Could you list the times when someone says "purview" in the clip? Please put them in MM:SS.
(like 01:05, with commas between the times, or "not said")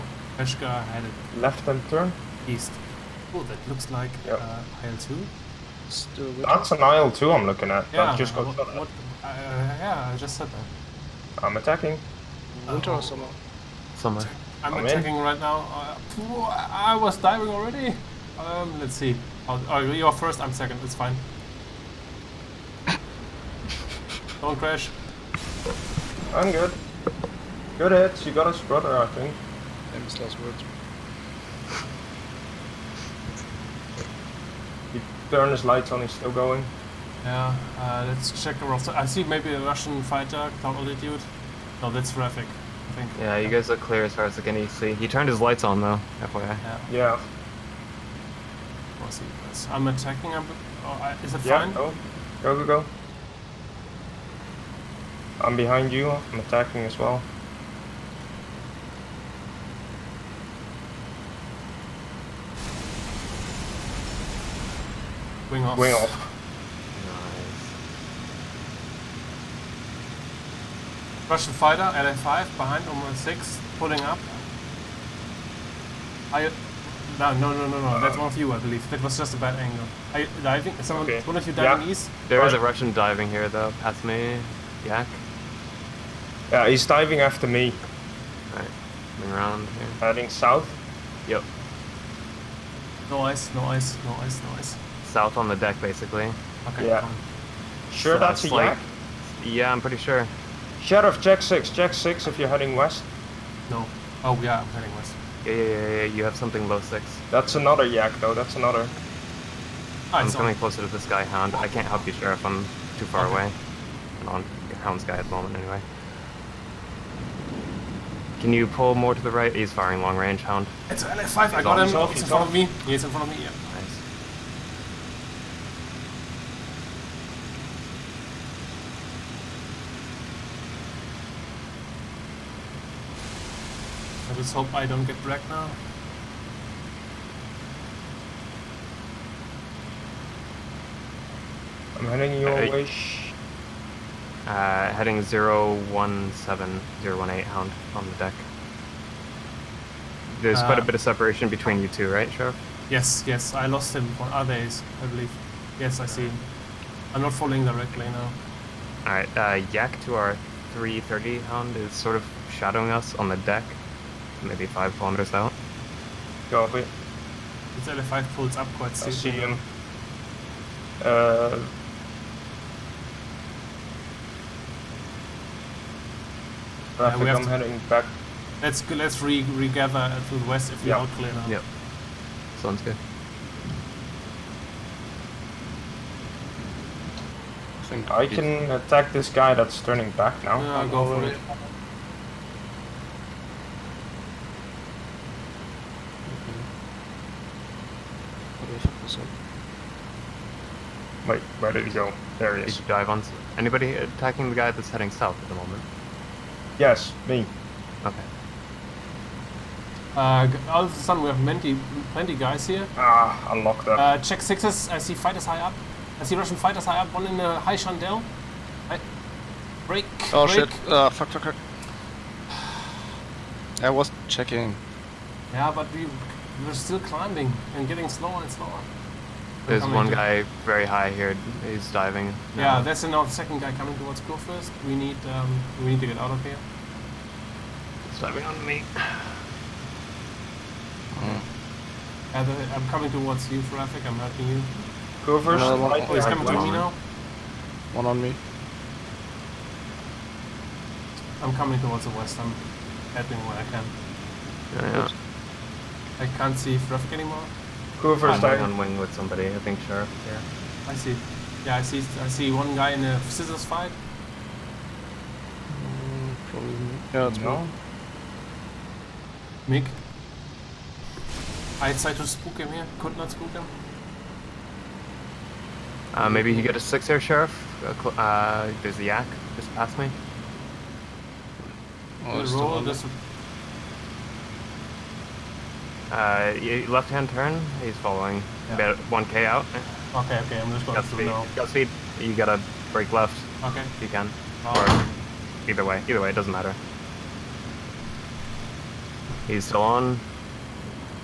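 not said.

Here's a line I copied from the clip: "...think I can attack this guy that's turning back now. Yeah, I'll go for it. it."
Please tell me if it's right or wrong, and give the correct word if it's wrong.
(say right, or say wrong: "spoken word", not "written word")
right.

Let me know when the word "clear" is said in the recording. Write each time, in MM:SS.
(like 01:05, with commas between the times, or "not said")
00:43, 03:01.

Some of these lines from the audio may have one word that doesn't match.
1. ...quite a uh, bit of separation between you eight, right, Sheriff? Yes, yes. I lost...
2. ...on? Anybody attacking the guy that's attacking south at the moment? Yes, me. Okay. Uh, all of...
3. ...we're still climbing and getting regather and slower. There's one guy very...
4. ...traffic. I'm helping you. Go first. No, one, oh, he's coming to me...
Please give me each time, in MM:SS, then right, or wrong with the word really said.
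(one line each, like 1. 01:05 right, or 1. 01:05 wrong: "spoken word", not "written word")
1. 02:30 wrong: "two", not "eight"
2. 03:23 wrong: "heading", not "attacking"
3. 03:46 wrong: "slower", not "regather"
4. 04:03 right.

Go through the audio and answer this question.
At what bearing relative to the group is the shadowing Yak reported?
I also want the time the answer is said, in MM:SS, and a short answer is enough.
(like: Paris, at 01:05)
330, at 02:40.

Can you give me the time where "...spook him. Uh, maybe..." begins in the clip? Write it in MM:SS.
04:33.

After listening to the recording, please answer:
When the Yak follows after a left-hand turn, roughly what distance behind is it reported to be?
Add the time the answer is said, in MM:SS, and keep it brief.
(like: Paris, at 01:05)
1k, at 04:49.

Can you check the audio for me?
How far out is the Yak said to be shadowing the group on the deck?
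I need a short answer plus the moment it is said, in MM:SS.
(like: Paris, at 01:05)
5 kilometers, at 02:44.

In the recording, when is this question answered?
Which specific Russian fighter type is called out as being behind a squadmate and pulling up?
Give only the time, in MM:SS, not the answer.
01:11.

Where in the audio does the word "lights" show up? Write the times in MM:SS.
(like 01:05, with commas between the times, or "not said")
00:35, 00:45.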